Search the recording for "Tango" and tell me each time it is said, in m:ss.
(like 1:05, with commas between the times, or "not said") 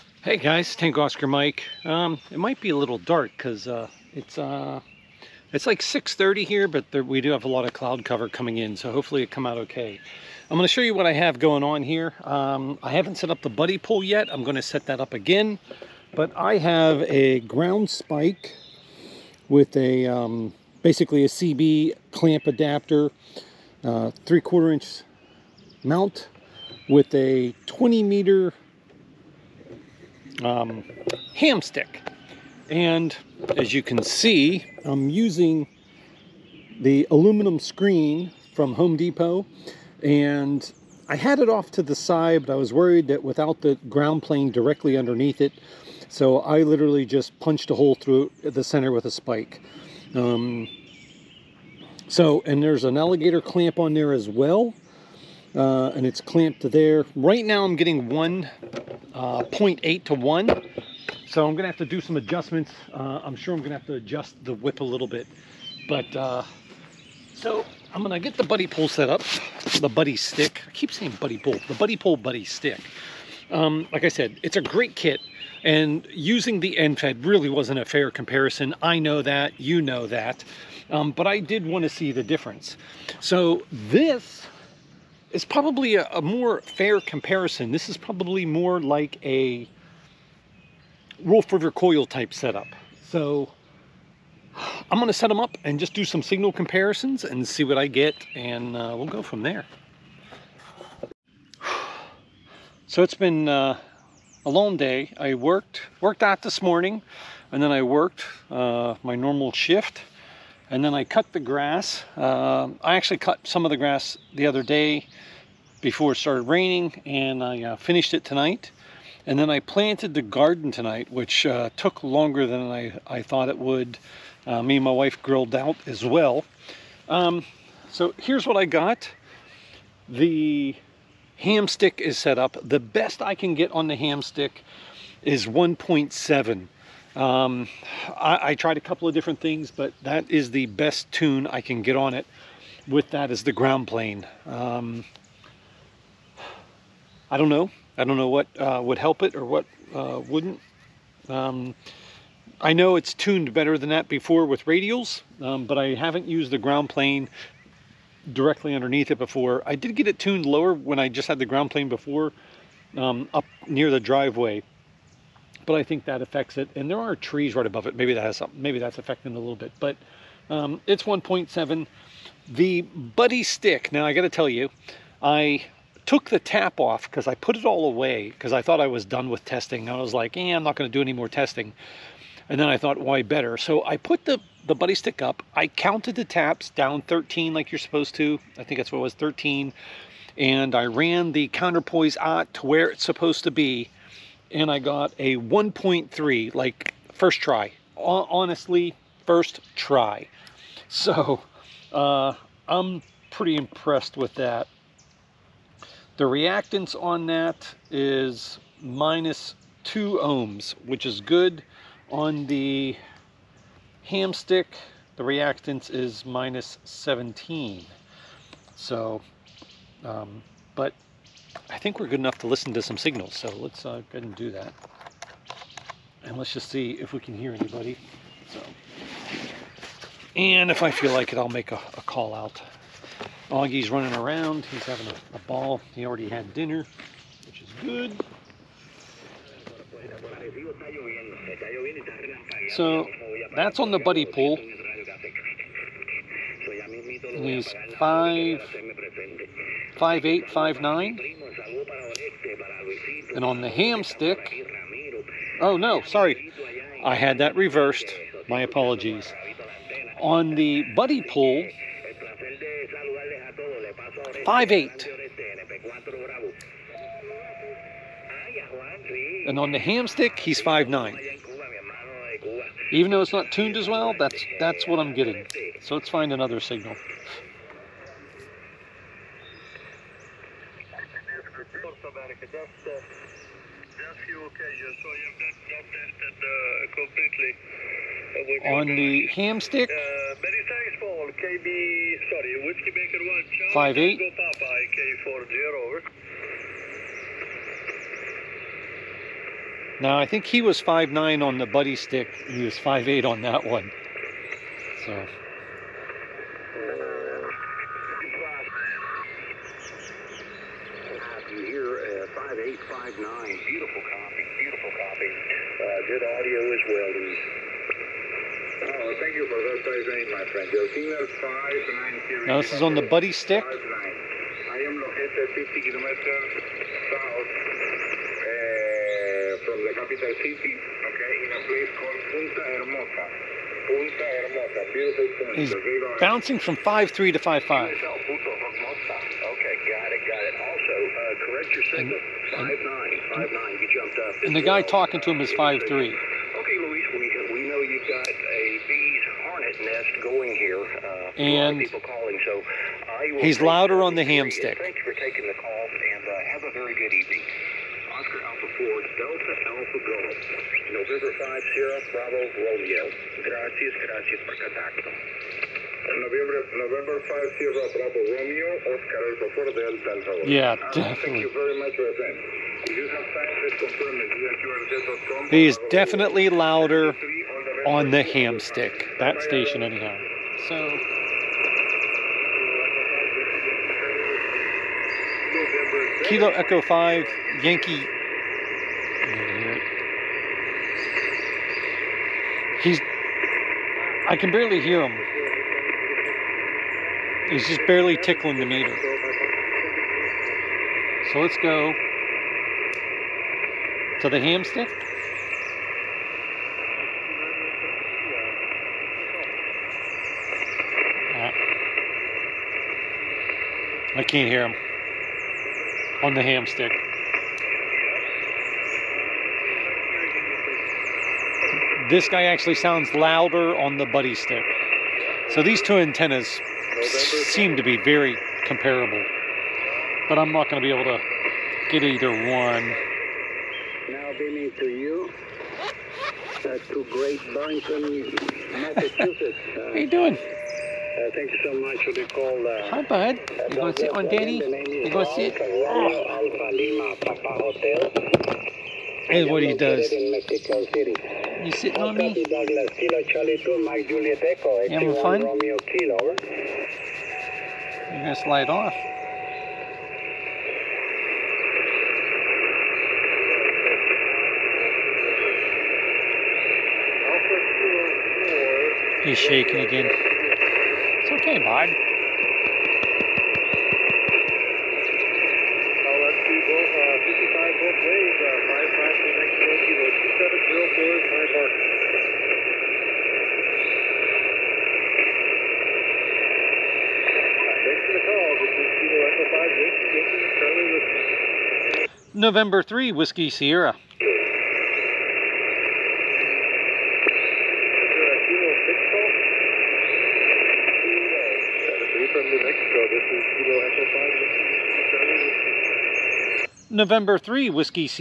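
0:00.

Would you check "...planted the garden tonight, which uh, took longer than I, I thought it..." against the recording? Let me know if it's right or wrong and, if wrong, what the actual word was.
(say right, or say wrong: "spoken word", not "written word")
right.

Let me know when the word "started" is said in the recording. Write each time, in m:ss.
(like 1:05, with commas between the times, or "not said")
1:56.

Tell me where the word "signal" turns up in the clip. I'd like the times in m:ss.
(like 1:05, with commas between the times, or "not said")
1:36, 3:42, 4:36, 5:20, 5:41.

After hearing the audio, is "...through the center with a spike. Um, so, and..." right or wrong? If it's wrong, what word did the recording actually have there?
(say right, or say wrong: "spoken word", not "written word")
right.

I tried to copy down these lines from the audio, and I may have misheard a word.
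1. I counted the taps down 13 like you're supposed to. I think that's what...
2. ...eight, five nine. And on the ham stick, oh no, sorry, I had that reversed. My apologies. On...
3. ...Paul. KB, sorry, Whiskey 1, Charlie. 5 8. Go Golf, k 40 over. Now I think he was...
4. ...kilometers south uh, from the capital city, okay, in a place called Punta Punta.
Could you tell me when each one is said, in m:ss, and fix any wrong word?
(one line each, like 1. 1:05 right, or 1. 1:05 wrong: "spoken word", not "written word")
1. 3:05 right
2. 4:10 right
3. 4:51 wrong: "Papa", not "Golf"
4. 5:25 wrong: "Hermosa", not "Punta".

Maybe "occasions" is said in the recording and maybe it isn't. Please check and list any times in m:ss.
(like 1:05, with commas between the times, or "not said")
4:44.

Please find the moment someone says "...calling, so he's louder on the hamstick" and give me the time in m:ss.
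5:52.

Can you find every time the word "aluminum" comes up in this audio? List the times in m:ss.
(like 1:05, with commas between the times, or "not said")
0:37.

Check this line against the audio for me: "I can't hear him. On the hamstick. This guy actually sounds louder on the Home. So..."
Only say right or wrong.
wrong.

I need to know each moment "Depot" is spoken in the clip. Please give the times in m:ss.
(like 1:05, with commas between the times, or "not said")
0:38.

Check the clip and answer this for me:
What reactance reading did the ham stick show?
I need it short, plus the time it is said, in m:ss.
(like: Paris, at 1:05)
minus 17, at 3:36.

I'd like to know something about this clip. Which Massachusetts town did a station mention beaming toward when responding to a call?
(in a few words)
Great Barrington.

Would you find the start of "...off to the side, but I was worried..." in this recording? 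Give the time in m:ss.
0:41.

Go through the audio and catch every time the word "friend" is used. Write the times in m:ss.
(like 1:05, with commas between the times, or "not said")
5:20, 6:12.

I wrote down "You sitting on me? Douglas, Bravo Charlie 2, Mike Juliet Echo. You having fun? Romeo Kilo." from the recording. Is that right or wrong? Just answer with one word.
wrong.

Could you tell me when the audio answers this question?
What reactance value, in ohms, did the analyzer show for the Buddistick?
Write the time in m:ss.
3:28.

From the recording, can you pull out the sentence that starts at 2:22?
With that is the ground plane.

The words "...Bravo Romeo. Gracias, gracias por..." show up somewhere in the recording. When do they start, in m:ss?
6:02.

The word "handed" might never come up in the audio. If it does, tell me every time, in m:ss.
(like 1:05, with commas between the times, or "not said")
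not said.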